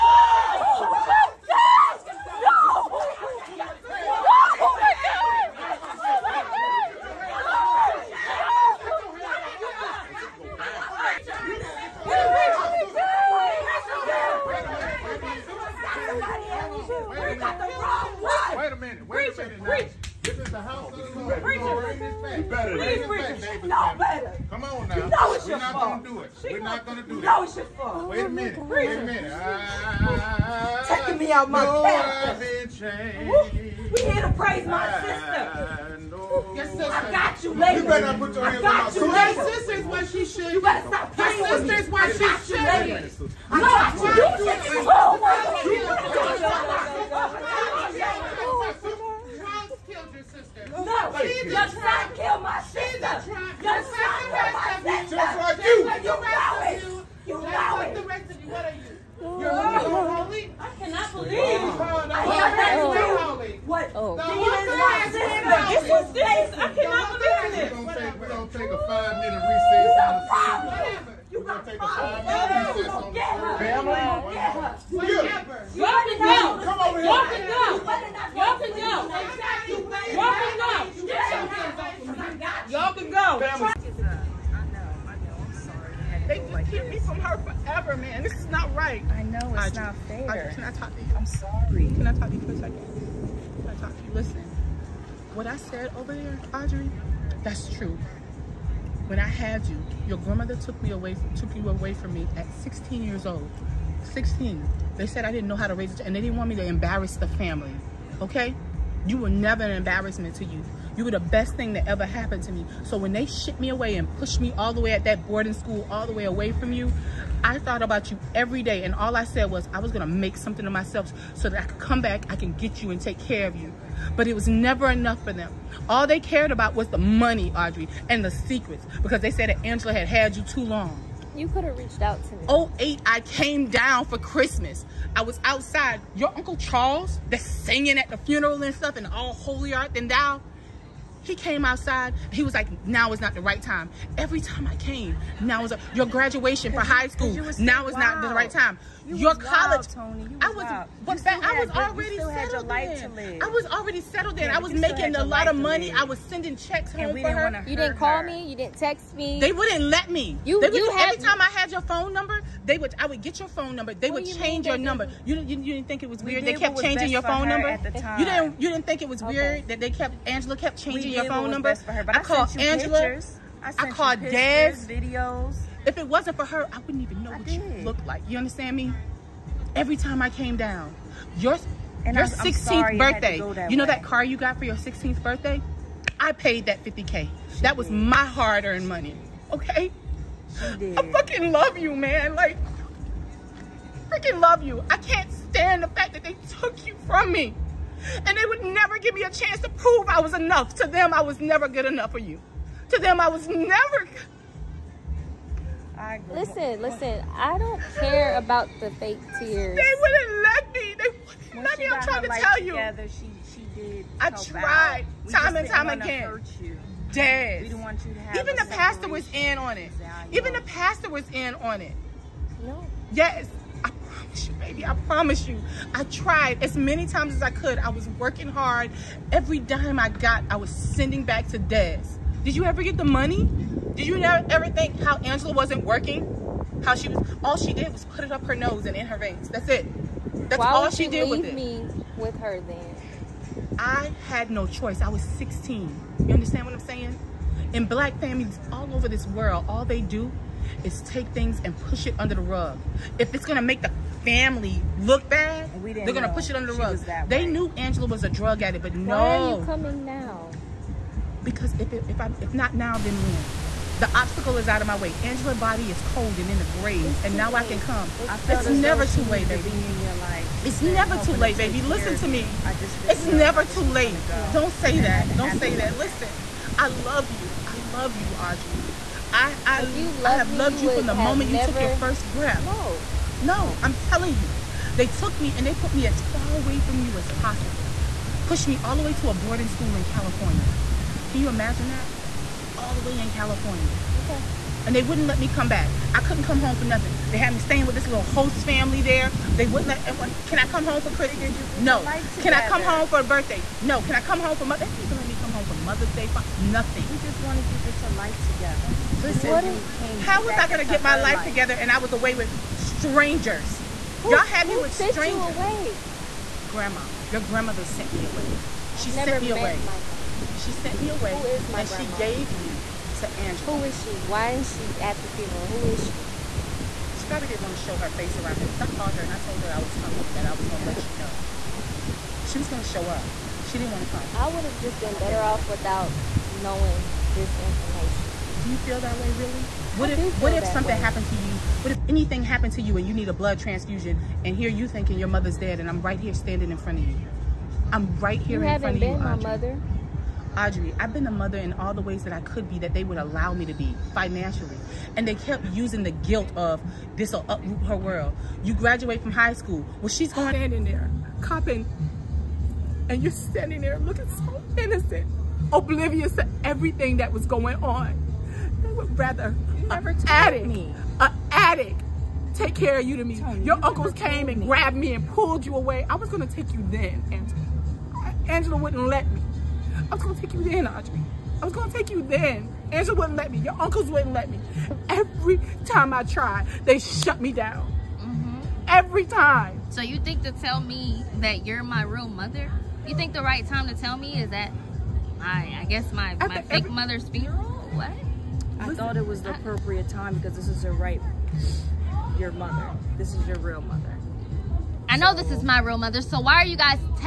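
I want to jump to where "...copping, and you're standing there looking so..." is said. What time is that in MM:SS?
06:01.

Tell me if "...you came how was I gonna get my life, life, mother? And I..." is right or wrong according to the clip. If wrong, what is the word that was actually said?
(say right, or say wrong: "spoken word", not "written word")
wrong: "together", not "mother".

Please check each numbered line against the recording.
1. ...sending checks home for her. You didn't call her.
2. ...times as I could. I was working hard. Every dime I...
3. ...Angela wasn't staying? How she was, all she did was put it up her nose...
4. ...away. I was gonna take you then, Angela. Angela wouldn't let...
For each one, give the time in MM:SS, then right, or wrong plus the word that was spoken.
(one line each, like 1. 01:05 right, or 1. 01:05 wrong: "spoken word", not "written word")
1. 02:36 right
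2. 03:47 right
3. 03:55 wrong: "working", not "staying"
4. 06:15 right.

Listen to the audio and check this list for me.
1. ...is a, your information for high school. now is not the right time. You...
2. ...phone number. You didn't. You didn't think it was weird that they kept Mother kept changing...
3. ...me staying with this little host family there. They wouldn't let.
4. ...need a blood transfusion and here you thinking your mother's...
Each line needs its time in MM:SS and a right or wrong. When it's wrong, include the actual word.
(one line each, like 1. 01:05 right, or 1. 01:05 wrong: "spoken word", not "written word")
1. 02:25 wrong: "graduation", not "information"
2. 02:47 wrong: "Angela", not "Mother"
3. 04:57 right
4. 05:43 right.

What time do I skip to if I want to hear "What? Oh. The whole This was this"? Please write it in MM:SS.
01:03.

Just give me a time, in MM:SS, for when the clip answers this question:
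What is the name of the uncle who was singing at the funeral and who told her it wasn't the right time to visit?
02:16.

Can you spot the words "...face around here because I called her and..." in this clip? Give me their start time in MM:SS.
05:28.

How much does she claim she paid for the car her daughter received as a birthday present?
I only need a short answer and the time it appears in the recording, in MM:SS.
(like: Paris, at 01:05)
$50k, at 03:06.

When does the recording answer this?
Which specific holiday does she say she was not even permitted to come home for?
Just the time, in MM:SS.
05:05.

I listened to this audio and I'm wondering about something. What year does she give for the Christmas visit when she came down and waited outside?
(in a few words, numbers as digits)
2008.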